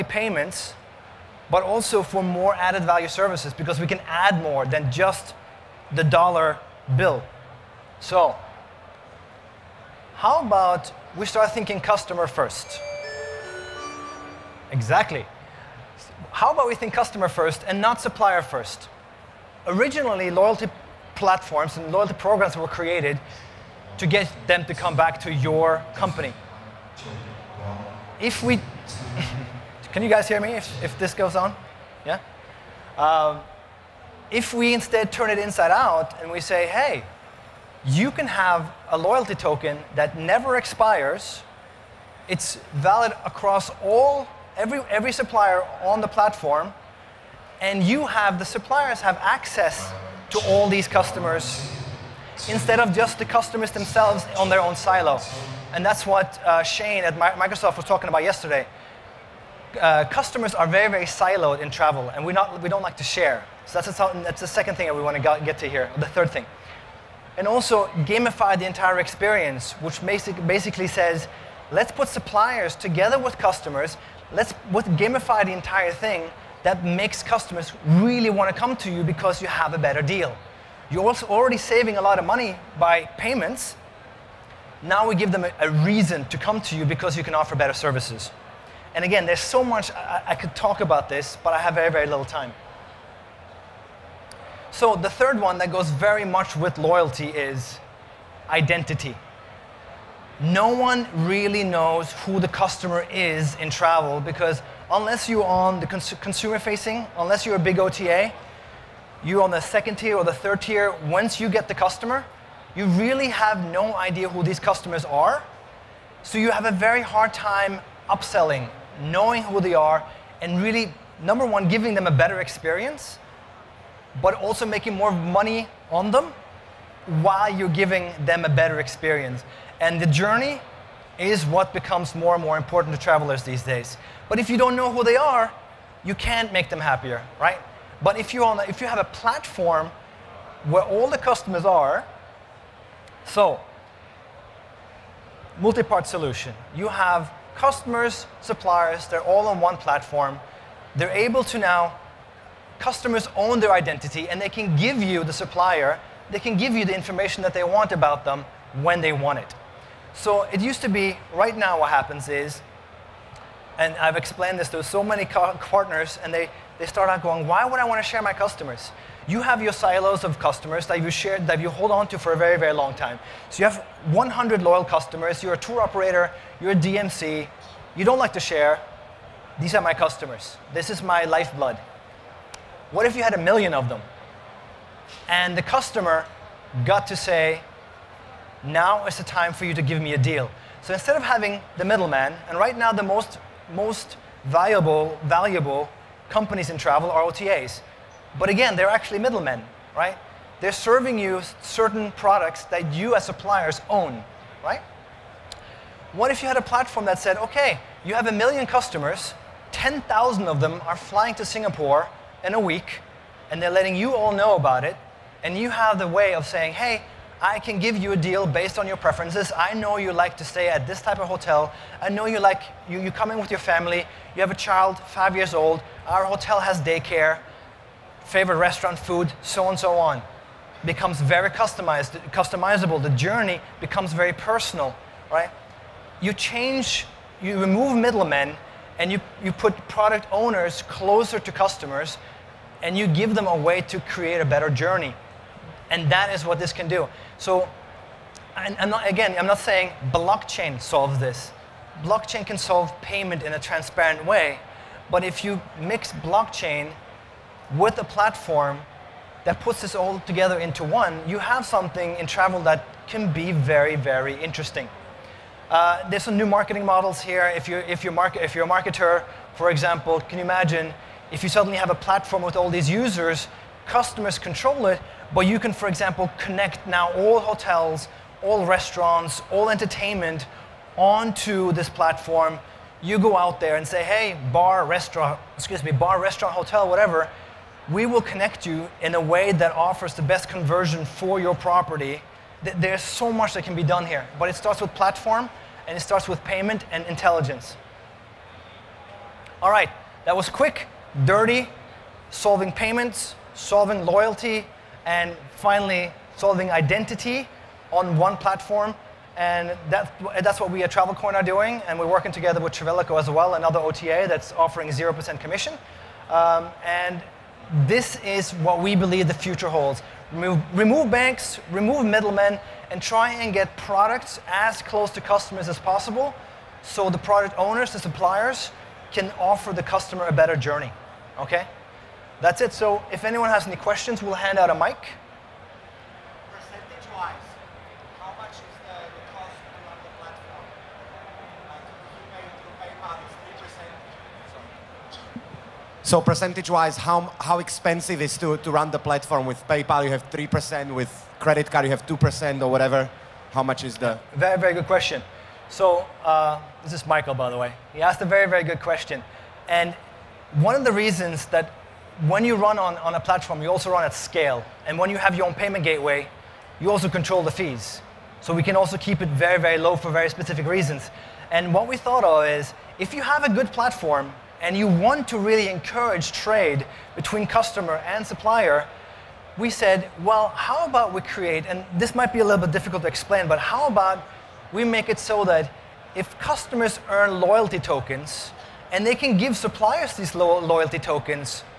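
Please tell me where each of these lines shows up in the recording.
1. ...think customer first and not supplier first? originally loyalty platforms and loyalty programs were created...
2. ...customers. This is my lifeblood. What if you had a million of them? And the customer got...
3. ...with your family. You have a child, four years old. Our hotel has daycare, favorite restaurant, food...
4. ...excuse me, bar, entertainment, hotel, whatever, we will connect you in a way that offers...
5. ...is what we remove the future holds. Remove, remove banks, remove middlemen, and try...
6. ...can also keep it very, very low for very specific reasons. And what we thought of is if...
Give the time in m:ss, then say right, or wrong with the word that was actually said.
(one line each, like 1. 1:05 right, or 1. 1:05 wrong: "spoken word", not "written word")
1. 0:16 right
2. 2:59 right
3. 3:43 wrong: "five", not "four"
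4. 4:45 wrong: "restaurant", not "entertainment"
5. 5:18 wrong: "believe", not "remove"
6. 6:08 right.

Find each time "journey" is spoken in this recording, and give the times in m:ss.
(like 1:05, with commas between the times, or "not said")
2:10, 3:53, 4:04, 5:30.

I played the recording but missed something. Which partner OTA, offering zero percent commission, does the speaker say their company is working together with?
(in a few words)
Travelico.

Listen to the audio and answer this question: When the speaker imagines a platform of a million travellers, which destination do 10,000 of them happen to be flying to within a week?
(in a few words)
Singapore.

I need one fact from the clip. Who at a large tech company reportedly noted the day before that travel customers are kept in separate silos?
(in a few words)
Shane.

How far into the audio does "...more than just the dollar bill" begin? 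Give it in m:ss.
0:04.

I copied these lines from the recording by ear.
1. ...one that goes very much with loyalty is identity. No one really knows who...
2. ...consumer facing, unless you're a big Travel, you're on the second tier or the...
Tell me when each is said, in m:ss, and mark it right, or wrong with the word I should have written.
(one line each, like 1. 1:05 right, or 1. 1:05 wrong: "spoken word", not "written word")
1. 1:35 right
2. 1:46 wrong: "OTA", not "Travel".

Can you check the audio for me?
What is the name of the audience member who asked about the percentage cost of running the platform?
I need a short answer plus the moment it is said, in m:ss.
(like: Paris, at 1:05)
Michael, at 5:57.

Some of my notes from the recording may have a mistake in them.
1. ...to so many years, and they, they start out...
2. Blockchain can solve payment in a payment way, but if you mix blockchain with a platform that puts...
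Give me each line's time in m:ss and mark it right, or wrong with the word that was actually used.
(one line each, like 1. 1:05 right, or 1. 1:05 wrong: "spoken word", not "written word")
1. 2:44 wrong: "partners", not "years"
2. 4:12 wrong: "transparent", not "payment".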